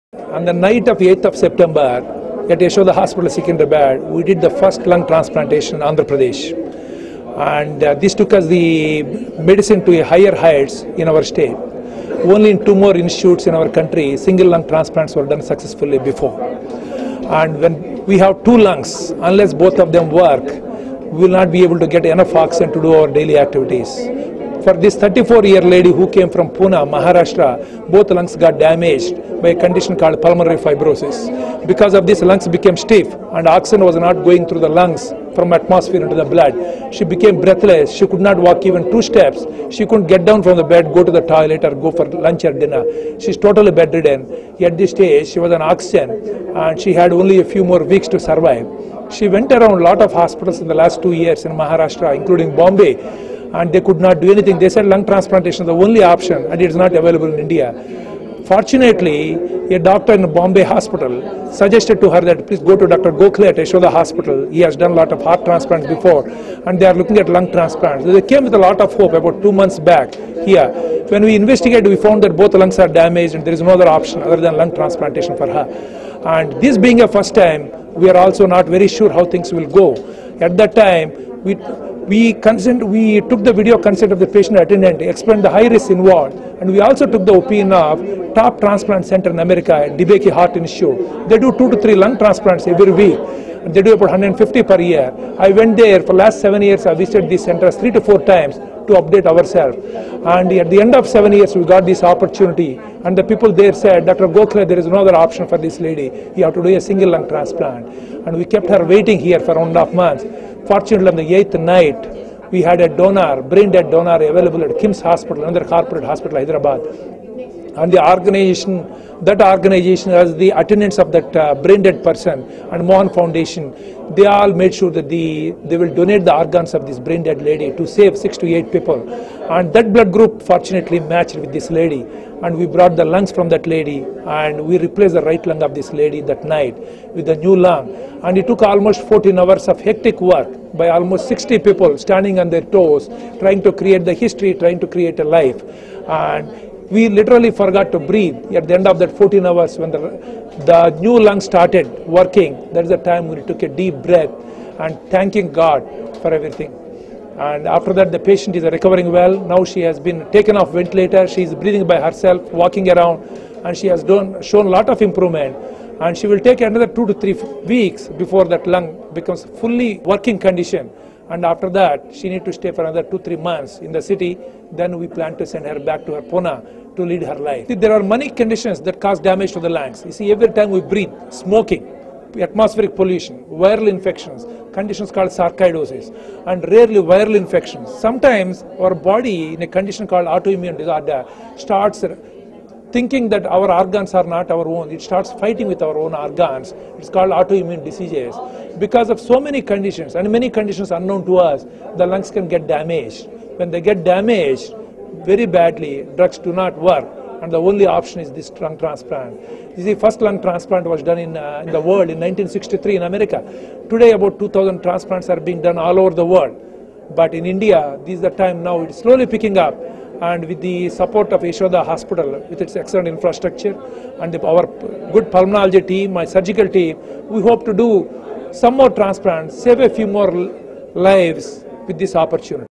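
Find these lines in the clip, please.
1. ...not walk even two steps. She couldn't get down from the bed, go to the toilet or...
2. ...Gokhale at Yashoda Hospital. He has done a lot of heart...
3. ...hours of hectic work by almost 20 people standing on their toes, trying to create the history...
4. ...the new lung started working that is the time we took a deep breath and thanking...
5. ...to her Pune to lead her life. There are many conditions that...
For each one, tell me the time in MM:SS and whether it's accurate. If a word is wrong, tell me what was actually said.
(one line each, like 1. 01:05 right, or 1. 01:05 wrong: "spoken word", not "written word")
1. 00:38 right
2. 01:03 right
3. 02:19 wrong: "60", not "20"
4. 02:30 right
5. 02:56 right.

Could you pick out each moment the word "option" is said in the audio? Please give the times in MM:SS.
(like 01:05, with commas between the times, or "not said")
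00:56, 01:13, 01:45, 03:27.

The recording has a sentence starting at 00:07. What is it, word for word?
And uh, this took us the medicine to higher heights in our state.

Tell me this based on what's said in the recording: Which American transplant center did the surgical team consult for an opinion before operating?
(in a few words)
DBK Heart Institute.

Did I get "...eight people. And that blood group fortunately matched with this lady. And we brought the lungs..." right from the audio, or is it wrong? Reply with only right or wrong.
right.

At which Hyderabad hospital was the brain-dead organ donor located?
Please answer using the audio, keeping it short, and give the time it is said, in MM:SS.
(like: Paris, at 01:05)
KIMS Hospital, at 01:54.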